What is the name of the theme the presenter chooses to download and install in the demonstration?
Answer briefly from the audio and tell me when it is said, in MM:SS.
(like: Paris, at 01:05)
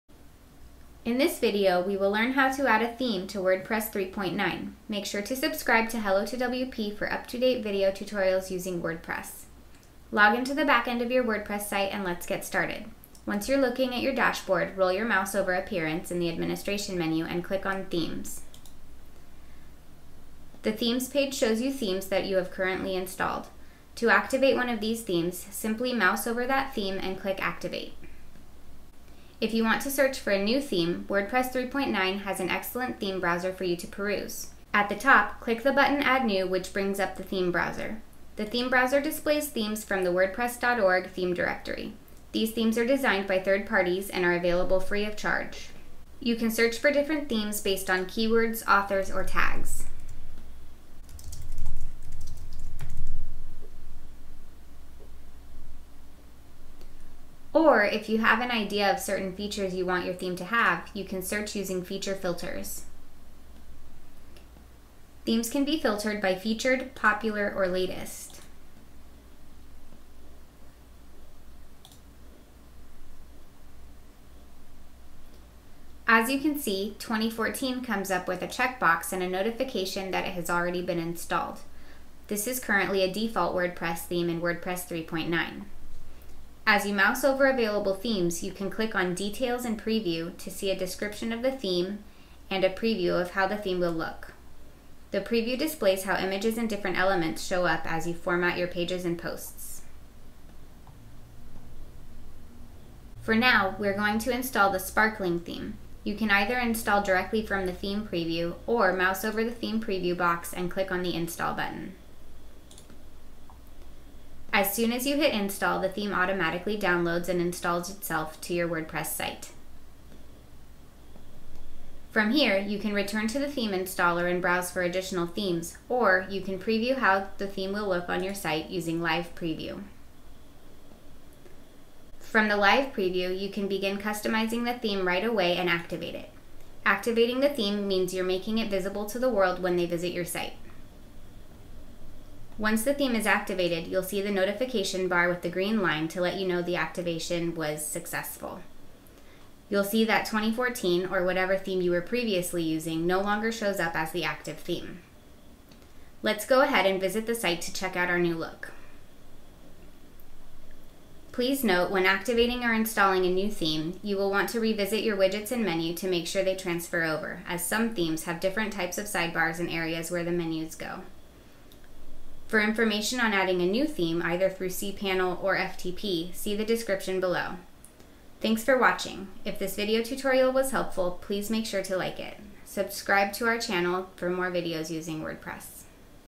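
Sparkling, at 01:44.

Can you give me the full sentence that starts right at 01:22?
This is currently a default WordPress theme in WordPress 3.9.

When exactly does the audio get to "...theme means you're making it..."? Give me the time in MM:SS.
02:17.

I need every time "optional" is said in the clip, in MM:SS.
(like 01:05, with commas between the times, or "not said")
not said.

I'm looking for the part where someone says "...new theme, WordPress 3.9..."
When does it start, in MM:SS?
00:30.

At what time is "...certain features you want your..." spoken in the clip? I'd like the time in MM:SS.
00:58.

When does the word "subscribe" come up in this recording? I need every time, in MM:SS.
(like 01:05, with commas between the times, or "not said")
00:05, 03:02.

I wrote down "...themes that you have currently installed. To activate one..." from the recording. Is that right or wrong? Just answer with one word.
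right.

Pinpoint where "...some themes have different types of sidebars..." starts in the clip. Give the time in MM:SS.
02:47.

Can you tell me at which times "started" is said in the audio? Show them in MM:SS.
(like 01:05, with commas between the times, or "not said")
00:12.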